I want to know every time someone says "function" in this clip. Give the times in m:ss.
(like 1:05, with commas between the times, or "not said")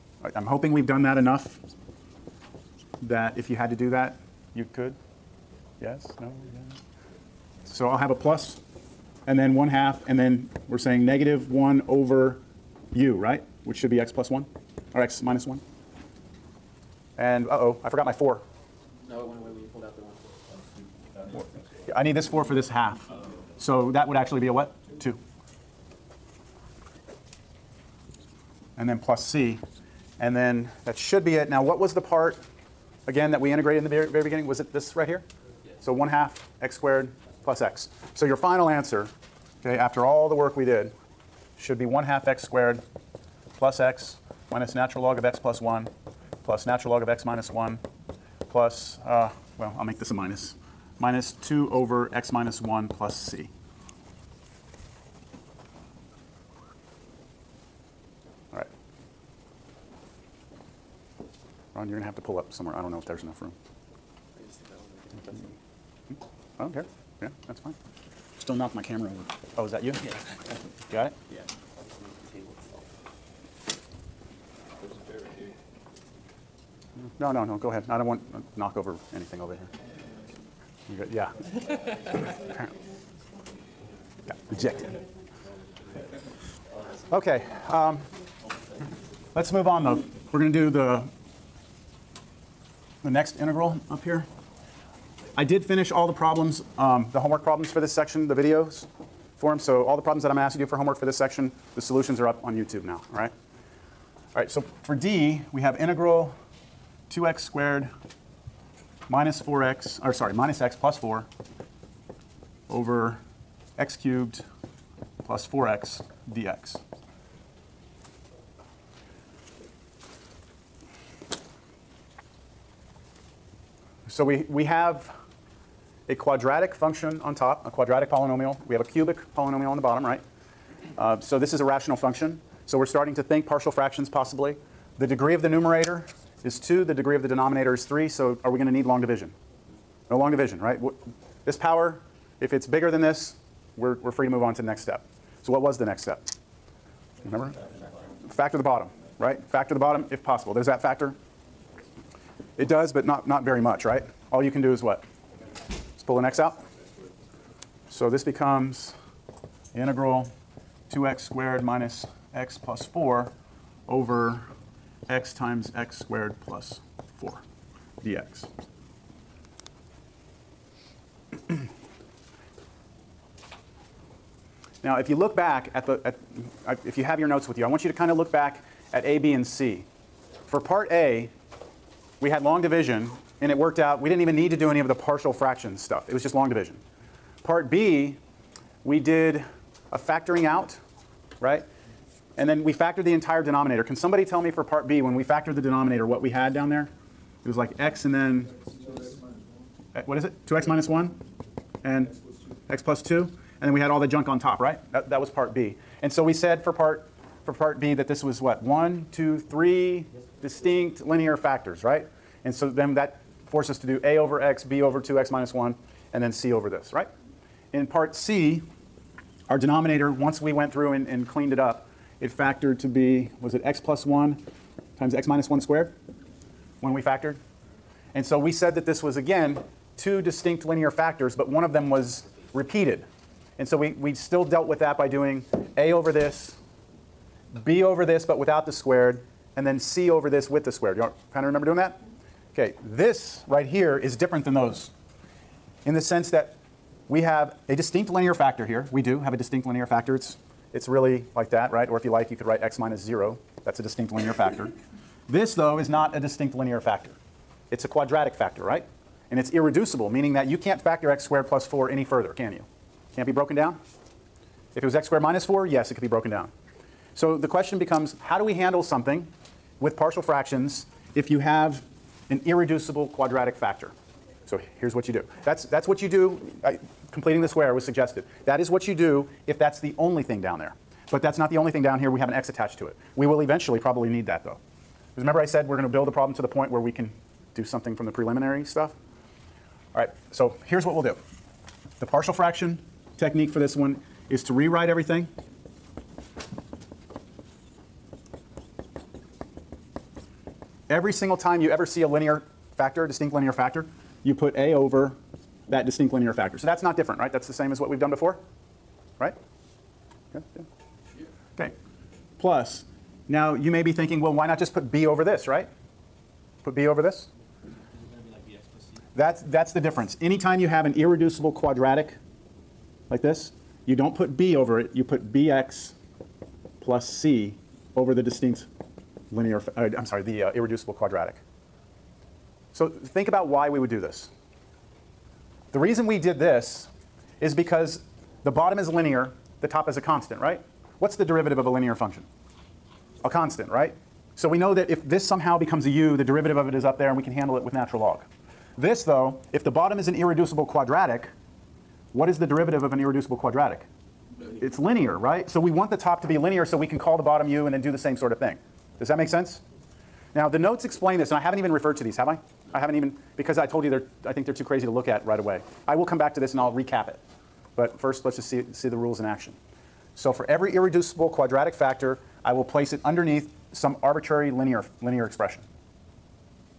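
2:06, 2:11, 5:41.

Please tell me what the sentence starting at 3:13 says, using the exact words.
Can somebody tell me for part B, when we factored the denominator, what we had down there?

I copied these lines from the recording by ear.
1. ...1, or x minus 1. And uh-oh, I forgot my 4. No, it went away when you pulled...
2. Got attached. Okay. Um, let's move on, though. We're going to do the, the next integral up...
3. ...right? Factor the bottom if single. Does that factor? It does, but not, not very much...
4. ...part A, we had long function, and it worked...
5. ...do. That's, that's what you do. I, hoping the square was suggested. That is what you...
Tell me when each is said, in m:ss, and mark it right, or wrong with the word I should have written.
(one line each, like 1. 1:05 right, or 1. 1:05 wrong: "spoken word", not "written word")
1. 0:14 right
2. 1:24 wrong: "rejected", not "attached"
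3. 2:29 wrong: "possible", not "single"
4. 3:00 wrong: "division", not "function"
5. 4:35 wrong: "completing", not "hoping".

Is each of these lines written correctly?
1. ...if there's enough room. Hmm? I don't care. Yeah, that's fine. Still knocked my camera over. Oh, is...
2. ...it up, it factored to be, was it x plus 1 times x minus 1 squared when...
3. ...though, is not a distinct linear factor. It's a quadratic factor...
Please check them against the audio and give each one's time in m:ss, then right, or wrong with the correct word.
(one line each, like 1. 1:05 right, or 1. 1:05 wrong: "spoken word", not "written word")
1. 1:02 right
2. 3:41 right
3. 4:15 right.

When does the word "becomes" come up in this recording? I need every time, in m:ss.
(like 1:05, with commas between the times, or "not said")
2:38, 4:27, 5:45.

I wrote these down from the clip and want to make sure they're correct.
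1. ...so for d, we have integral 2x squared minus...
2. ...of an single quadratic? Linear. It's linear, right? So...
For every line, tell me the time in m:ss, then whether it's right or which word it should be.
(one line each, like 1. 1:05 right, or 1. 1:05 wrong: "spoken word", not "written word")
1. 1:44 right
2. 5:52 wrong: "irreducible", not "single".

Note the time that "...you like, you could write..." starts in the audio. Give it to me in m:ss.
4:12.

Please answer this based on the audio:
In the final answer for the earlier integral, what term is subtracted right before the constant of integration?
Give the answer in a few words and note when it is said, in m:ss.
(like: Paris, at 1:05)
2 over x minus 1, at 0:50.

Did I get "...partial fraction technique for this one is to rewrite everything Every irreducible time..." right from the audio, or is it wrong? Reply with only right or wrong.
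wrong.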